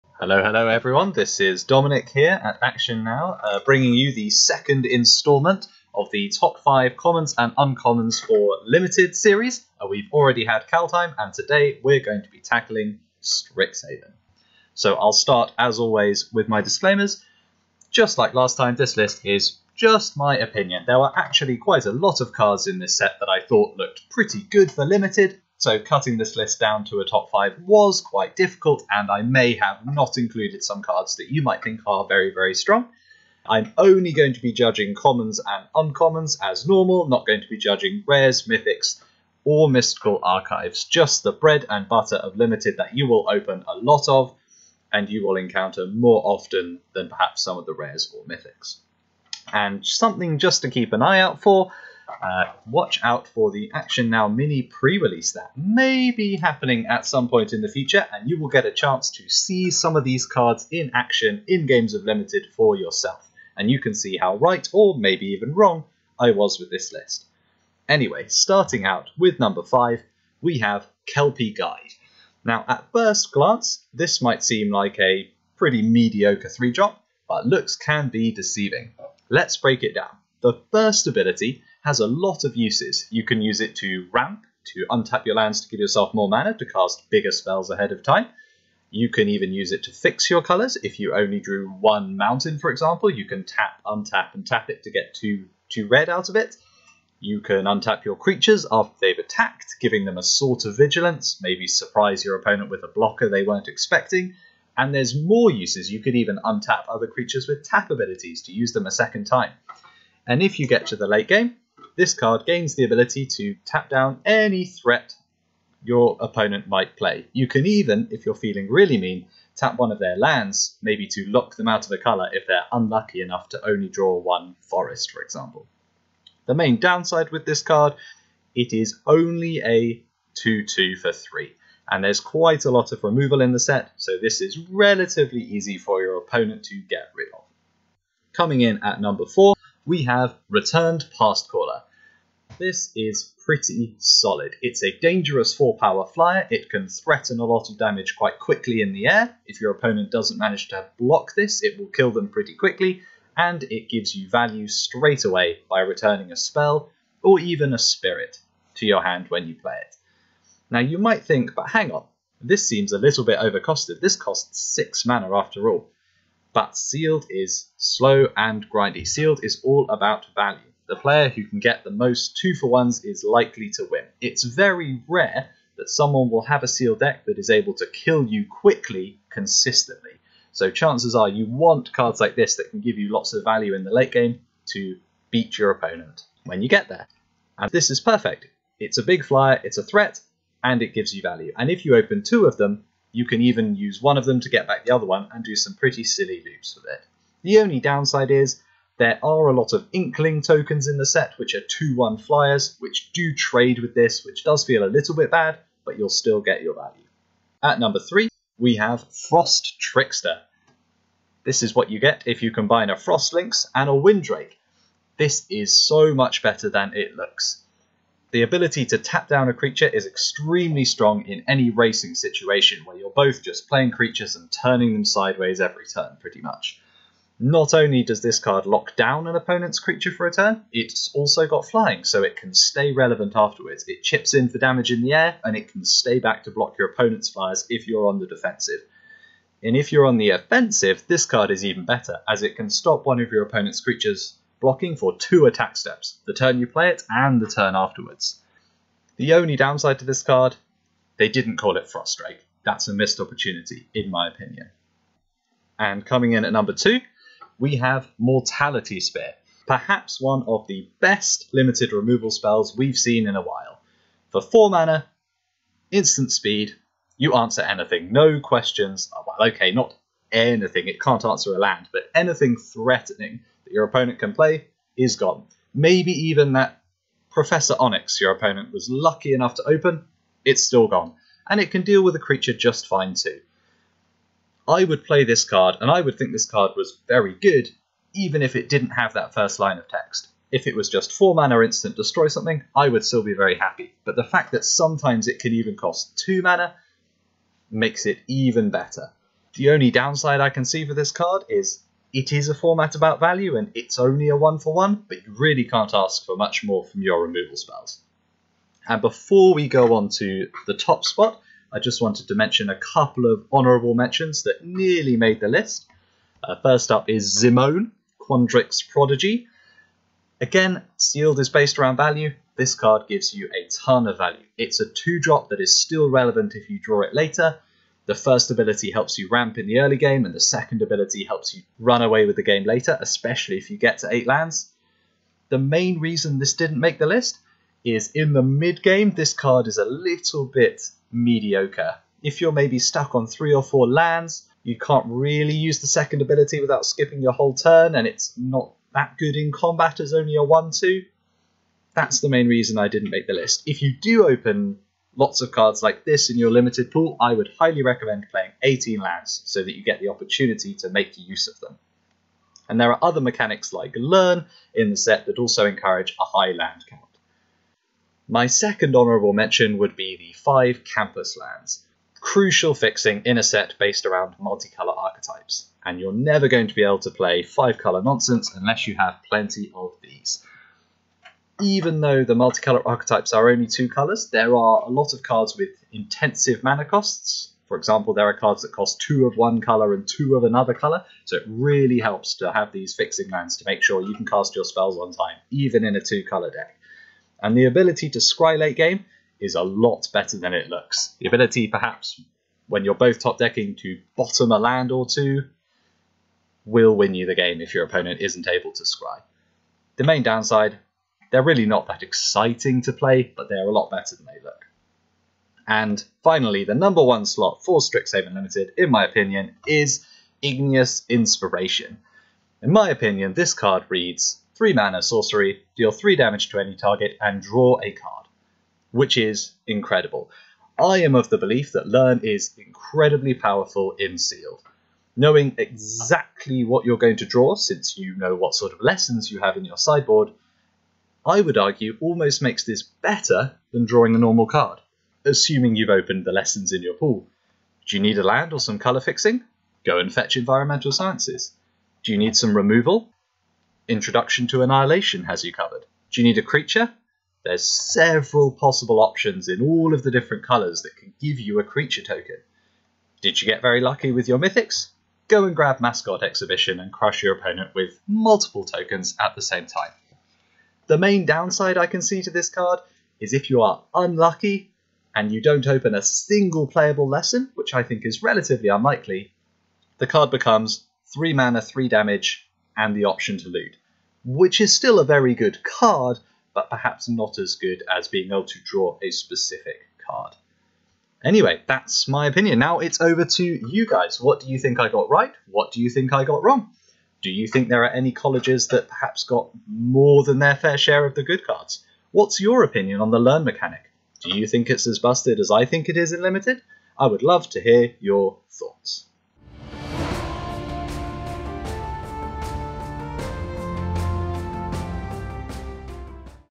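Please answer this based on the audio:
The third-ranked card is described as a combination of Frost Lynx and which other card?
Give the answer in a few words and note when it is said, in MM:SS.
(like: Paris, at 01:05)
Wind Drake, at 03:33.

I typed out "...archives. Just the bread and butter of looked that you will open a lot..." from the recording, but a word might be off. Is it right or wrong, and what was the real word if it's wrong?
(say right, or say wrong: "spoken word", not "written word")
wrong: "limited", not "looked".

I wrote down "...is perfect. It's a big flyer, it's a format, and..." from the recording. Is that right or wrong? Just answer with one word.
wrong.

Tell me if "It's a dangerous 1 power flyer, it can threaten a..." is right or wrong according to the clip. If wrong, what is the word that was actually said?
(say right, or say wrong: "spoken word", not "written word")
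wrong: "4", not "1".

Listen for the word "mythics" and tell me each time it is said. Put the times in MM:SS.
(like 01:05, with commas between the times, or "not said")
00:38, 00:48, 07:44.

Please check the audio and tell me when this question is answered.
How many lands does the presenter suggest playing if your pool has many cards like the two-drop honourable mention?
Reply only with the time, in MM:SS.
05:58.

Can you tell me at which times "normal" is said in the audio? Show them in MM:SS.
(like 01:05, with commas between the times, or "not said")
00:36, 07:24.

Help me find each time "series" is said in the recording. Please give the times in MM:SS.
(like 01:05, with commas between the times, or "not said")
00:09.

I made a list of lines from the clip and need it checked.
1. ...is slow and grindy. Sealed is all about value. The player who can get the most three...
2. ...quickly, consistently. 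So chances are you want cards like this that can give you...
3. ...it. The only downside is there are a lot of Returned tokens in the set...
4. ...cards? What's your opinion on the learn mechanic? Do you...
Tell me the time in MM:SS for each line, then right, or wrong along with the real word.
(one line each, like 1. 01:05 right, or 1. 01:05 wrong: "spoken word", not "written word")
1. 02:47 wrong: "two", not "three"
2. 02:58 right
3. 03:16 wrong: "Inkling", not "Returned"
4. 08:21 right.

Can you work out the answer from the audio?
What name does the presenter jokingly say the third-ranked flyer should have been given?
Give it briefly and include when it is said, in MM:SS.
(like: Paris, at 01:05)
Frostrike, at 04:11.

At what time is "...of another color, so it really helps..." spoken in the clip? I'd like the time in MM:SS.
06:30.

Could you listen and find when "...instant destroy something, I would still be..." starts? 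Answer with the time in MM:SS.
04:51.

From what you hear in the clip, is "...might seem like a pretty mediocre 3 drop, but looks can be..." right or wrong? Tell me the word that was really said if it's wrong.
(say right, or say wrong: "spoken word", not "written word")
right.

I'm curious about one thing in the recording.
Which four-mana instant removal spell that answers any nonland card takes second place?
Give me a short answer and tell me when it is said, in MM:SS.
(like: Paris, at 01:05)
Mortality Spear, at 04:18.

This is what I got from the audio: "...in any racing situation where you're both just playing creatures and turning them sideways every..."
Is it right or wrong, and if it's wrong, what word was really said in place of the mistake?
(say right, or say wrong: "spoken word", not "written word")
right.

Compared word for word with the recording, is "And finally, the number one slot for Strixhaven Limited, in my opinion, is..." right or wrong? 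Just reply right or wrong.
right.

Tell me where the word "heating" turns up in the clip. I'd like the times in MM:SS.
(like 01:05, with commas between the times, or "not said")
not said.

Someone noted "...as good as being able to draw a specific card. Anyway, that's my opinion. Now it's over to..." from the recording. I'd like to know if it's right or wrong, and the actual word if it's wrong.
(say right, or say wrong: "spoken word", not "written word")
right.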